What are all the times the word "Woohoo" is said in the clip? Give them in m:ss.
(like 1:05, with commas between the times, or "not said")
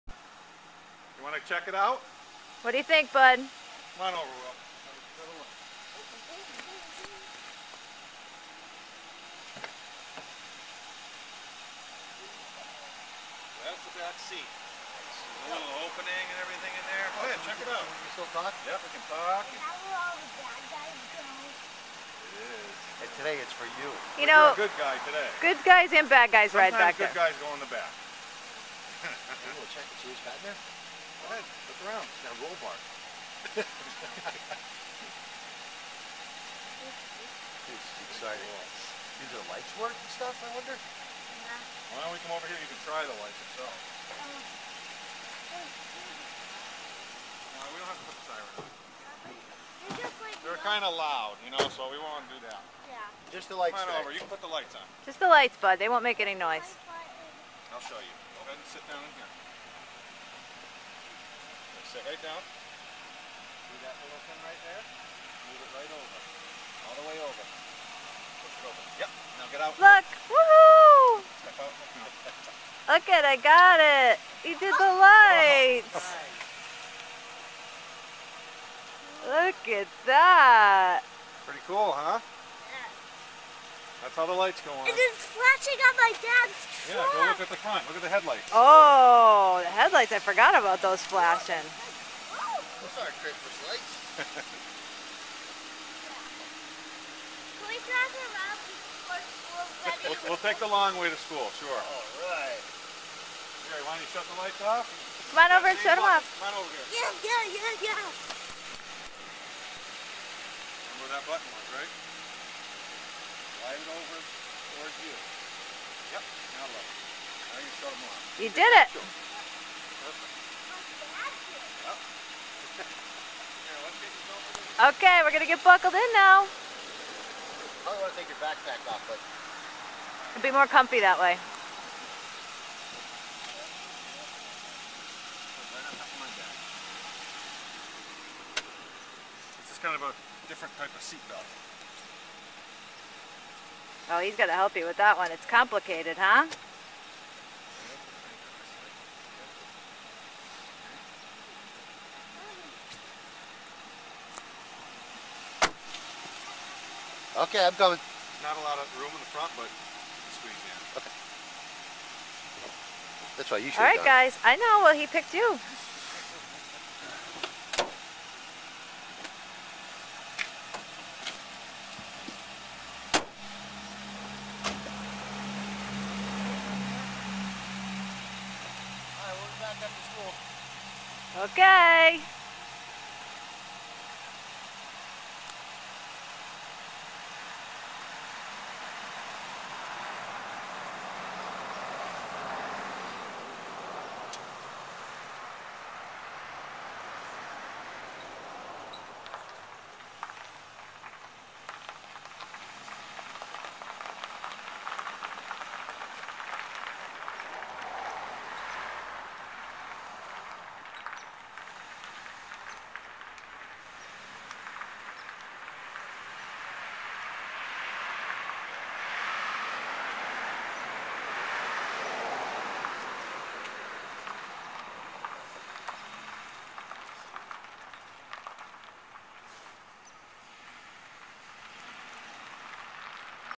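1:10.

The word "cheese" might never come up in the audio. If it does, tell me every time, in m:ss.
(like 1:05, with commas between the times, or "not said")
0:30.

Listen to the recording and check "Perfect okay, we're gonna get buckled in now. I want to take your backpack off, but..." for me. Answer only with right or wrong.
right.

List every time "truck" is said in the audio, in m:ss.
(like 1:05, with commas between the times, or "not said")
1:26.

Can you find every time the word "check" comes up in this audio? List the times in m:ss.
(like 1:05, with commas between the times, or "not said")
0:01, 0:17, 0:29.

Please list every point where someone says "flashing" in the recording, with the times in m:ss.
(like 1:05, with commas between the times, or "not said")
1:25, 1:31.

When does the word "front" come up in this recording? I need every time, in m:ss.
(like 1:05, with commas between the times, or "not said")
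1:27, 2:39.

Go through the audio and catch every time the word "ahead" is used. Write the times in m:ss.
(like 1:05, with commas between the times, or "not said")
0:17, 0:31, 0:58.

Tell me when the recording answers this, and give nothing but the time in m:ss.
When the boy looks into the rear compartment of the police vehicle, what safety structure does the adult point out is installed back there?
0:32.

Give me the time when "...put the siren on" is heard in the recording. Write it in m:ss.
0:48.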